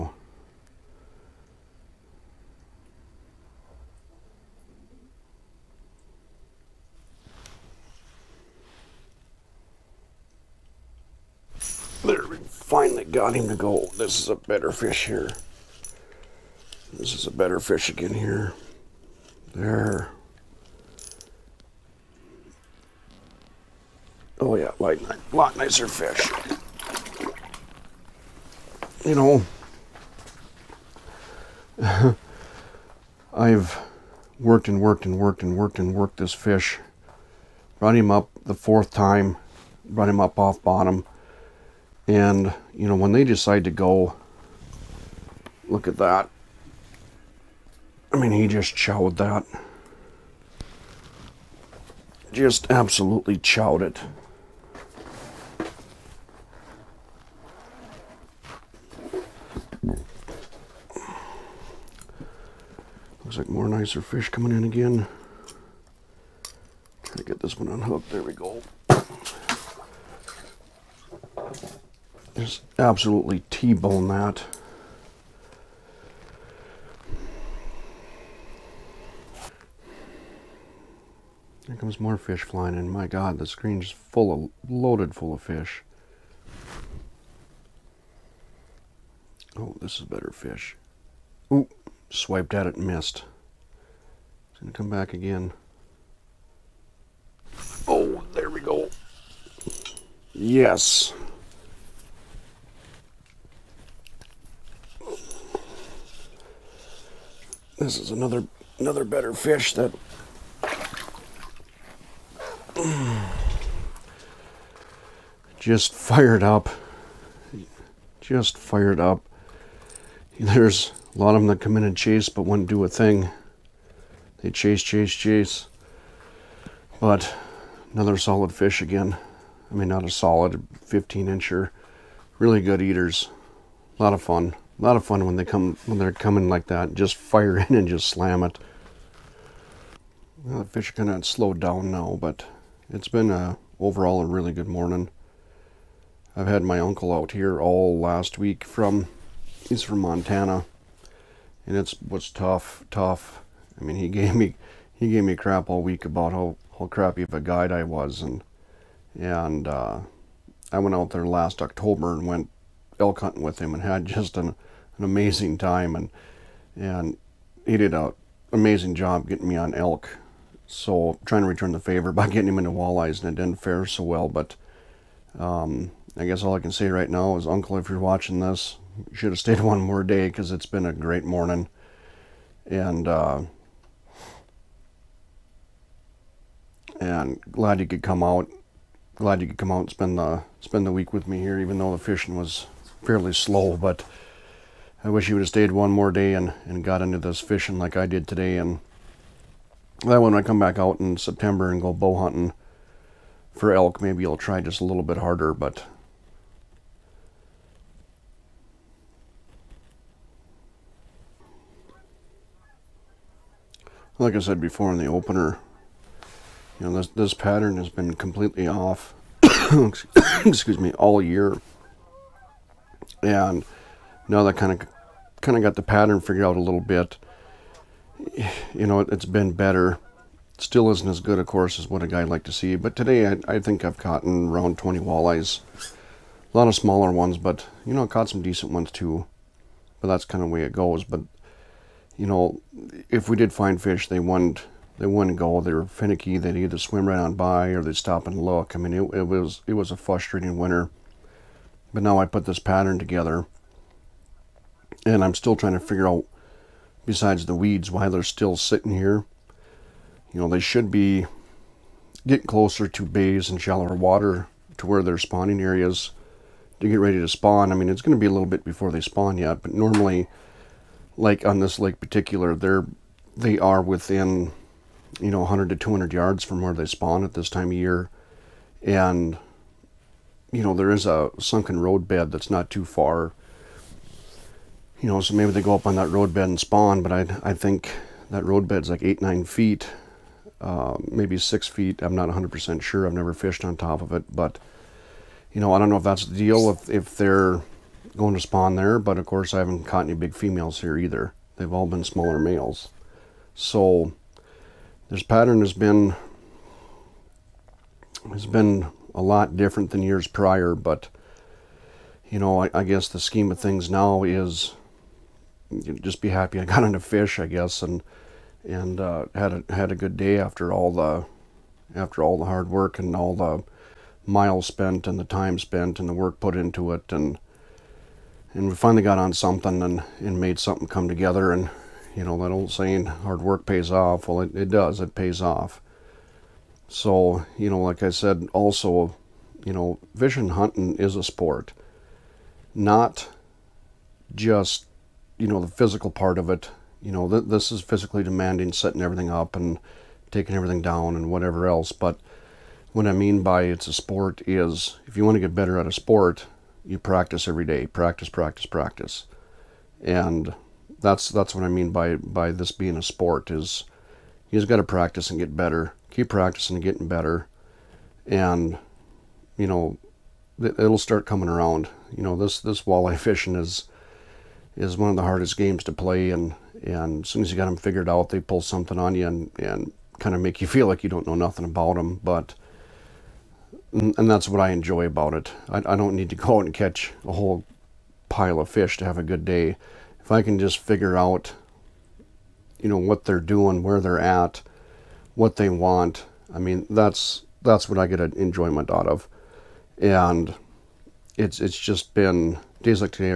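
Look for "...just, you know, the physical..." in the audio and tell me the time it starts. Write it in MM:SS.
05:44.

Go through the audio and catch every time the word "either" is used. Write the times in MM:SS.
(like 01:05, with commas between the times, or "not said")
04:06, 05:00.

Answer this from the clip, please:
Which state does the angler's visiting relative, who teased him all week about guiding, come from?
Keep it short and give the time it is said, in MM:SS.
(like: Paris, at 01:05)
Montana, at 02:29.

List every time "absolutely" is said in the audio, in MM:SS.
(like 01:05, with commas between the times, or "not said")
00:52, 01:12.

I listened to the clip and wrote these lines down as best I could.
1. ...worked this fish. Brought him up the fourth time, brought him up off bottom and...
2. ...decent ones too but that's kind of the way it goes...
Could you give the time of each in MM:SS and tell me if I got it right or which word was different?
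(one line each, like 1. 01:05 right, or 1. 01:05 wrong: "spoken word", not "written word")
1. 00:35 right
2. 03:58 right.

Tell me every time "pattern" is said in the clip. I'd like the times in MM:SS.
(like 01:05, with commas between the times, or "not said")
03:37, 03:45, 04:12, 05:05.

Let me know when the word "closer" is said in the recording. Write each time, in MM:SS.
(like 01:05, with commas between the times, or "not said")
04:22.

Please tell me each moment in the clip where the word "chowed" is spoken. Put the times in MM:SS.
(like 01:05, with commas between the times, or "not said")
00:48, 00:53.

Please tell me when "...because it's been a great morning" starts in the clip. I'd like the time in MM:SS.
03:00.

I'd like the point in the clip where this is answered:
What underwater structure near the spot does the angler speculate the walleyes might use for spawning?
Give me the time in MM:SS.
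04:41.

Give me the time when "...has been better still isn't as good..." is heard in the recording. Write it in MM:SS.
03:49.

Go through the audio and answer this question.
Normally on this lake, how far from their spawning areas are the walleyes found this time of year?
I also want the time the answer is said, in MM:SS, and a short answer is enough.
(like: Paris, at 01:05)
100 to 200 yards, at 04:35.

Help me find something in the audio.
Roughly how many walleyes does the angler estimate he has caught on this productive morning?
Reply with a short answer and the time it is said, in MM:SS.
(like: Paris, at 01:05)
20, at 03:54.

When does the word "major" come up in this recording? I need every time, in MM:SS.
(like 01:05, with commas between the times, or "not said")
not said.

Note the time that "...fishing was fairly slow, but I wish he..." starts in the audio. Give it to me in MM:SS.
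03:12.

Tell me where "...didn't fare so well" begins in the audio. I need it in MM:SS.
02:53.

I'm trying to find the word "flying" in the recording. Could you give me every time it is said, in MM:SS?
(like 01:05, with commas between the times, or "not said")
01:22.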